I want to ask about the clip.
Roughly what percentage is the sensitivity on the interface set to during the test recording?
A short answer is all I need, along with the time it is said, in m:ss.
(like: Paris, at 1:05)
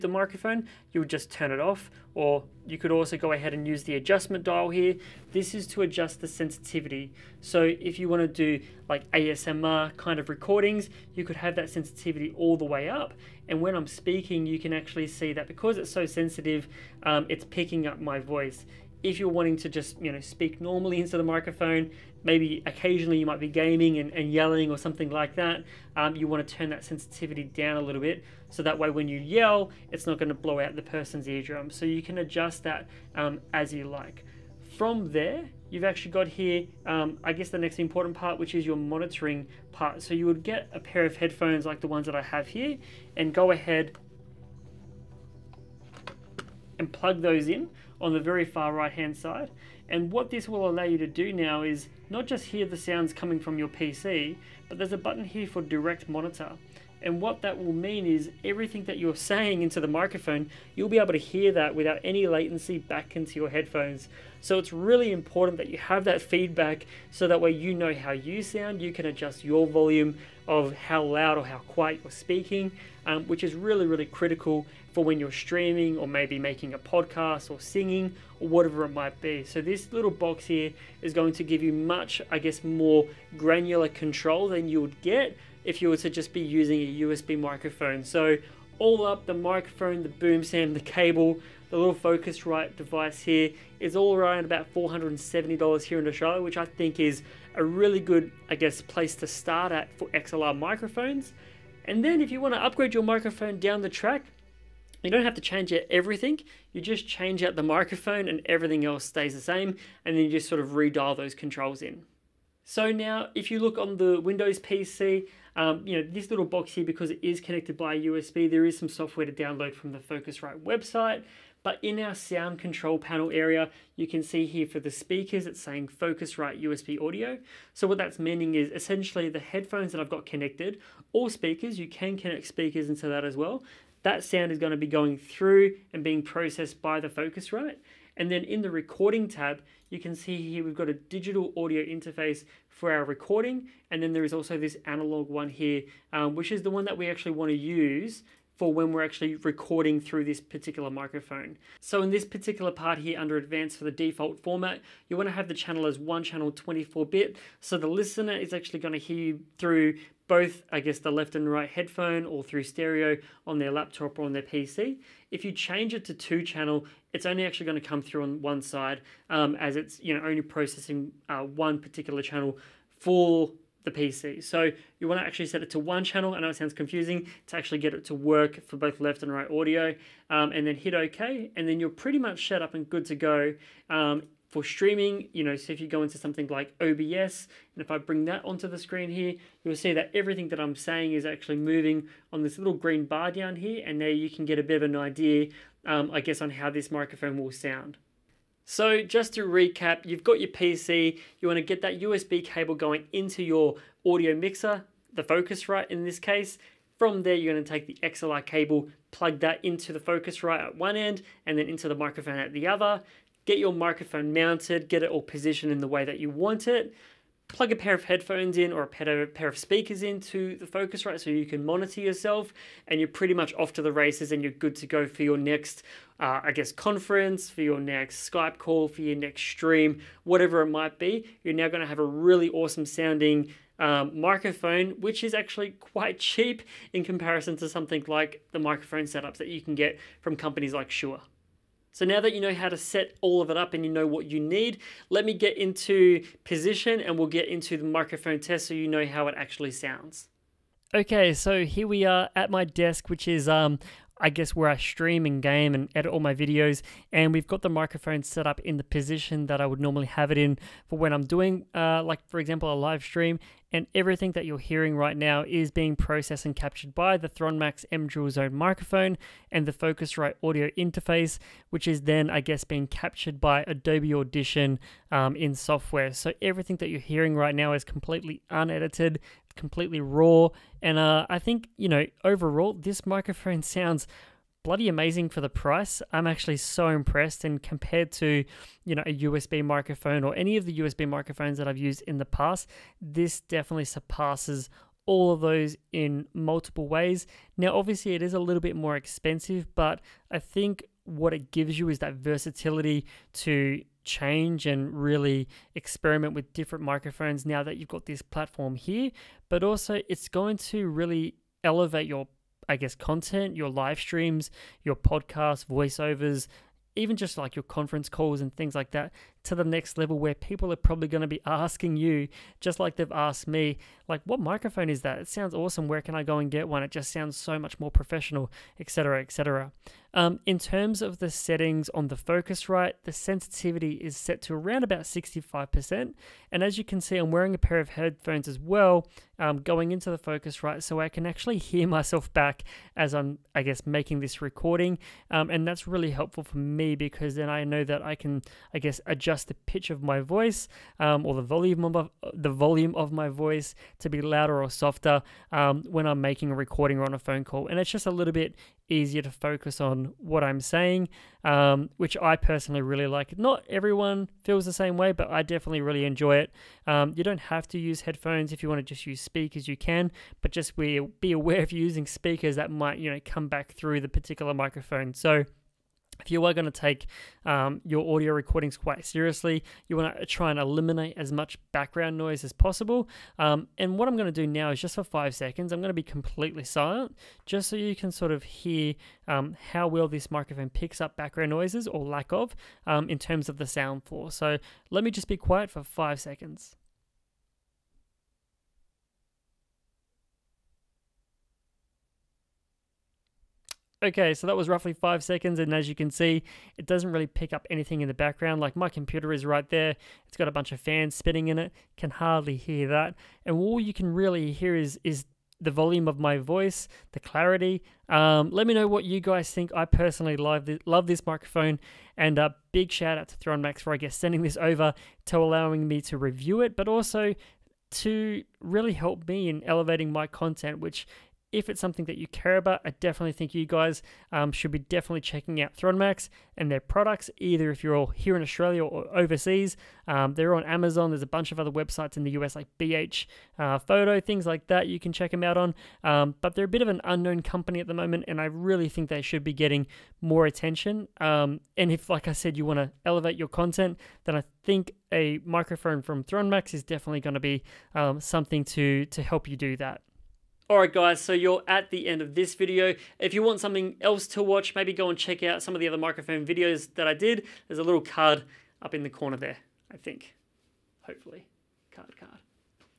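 65%, at 5:35.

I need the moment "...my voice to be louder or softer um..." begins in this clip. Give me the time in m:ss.
5:53.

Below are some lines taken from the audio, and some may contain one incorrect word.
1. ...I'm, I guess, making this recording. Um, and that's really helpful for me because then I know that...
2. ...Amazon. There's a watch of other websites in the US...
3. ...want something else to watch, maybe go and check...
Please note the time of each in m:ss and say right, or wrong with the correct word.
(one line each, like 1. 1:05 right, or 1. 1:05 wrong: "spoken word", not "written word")
1. 5:43 right
2. 7:20 wrong: "bunch", not "watch"
3. 7:43 right.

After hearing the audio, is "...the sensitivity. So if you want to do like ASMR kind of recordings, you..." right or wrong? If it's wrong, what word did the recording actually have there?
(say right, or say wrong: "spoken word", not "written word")
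right.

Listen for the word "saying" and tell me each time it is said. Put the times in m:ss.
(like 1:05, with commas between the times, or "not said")
0:59, 2:05, 3:10, 6:00.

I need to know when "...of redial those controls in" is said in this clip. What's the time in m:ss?
1:50.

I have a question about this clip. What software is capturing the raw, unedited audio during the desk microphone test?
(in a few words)
Adobe Audition.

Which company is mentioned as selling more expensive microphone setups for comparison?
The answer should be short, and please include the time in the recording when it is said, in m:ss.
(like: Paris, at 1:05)
Shure, at 4:00.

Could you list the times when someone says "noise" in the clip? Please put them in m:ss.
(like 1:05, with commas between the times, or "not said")
6:22, 6:31.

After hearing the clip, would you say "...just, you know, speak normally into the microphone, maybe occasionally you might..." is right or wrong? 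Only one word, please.
right.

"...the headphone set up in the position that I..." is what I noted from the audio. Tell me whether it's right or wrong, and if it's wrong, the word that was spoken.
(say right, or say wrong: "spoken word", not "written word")
wrong: "microphone", not "headphone".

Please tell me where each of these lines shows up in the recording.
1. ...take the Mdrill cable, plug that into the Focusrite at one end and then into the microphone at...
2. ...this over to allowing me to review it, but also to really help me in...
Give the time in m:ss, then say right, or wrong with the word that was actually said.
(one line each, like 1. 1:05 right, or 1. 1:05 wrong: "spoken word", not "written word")
1. 3:27 wrong: "XLR", not "Mdrill"
2. 7:04 right.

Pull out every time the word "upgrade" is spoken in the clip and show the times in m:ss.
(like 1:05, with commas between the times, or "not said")
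1:42.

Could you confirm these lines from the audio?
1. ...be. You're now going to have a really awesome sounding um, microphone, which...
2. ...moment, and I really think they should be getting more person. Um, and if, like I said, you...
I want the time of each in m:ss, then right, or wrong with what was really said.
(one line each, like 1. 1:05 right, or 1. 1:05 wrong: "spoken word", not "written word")
1. 3:50 right
2. 7:27 wrong: "attention", not "person".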